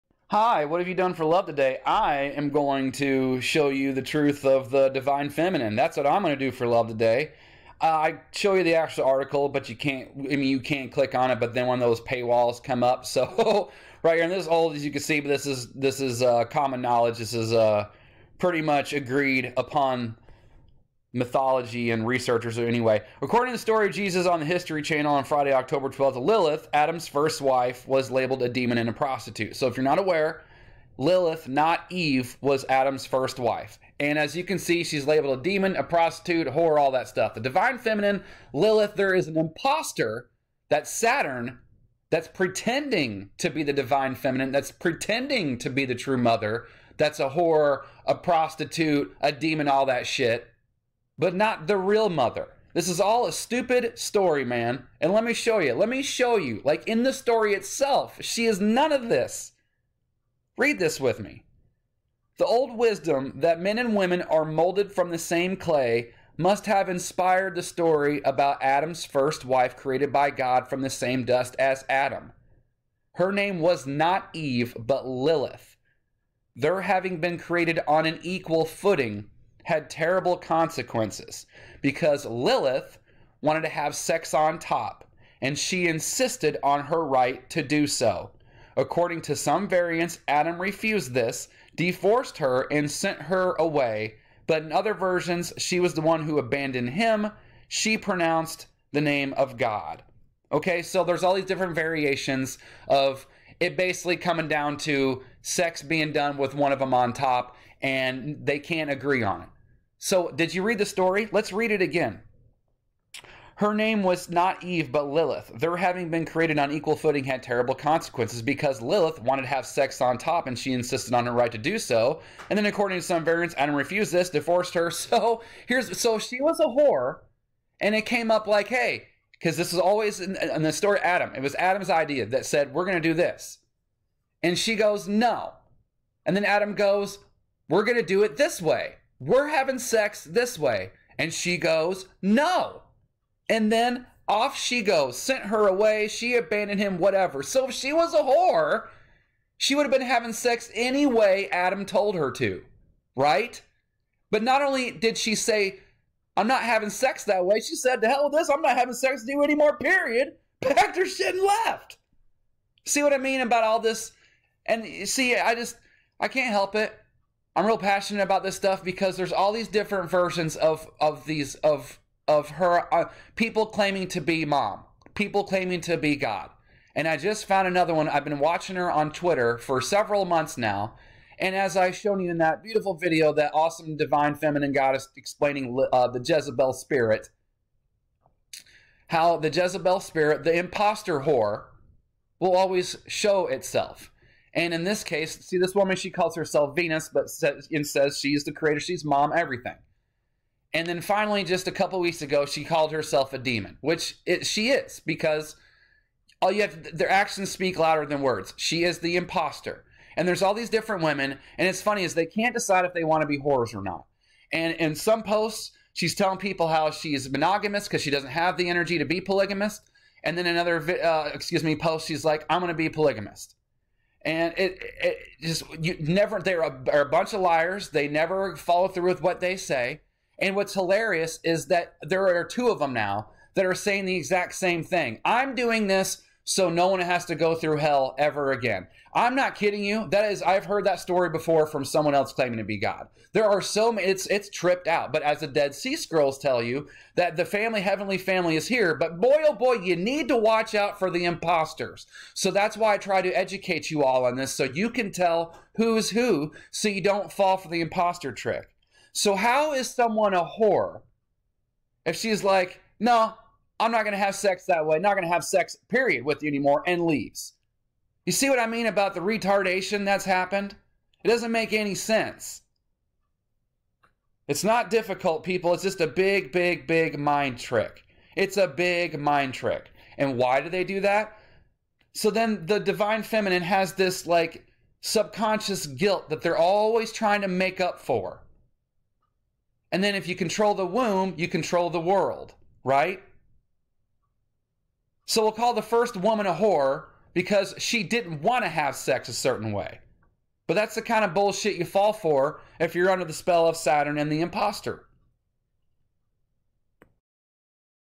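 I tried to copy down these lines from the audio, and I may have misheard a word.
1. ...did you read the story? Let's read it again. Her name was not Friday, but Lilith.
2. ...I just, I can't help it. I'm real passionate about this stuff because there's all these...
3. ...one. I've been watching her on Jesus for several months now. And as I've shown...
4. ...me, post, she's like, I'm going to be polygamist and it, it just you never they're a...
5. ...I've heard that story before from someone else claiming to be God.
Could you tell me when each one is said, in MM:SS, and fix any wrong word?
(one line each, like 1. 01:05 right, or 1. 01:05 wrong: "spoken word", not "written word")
1. 01:50 wrong: "Eve", not "Friday"
2. 02:45 right
3. 02:57 wrong: "Twitter", not "Jesus"
4. 03:41 right
5. 04:00 right.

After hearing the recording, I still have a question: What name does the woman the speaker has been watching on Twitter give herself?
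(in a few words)
Venus.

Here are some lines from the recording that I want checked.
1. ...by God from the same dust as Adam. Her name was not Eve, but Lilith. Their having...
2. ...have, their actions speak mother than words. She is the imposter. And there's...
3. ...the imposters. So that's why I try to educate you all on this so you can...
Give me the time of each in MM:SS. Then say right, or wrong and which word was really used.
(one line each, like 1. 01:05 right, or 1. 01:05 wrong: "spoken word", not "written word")
1. 01:10 right
2. 03:26 wrong: "louder", not "mother"
3. 04:11 right.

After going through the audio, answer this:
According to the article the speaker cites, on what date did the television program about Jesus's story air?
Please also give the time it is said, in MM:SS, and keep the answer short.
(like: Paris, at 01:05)
Friday, October 12th, at 00:25.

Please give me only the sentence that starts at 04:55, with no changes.
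So we'll call the first woman a whore because she didn't want to have sex a certain way.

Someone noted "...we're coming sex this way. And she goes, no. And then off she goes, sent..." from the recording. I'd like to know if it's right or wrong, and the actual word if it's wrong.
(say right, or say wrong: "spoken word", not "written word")
wrong: "having", not "coming".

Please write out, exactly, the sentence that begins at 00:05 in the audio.
That's what I'm going to do for love today.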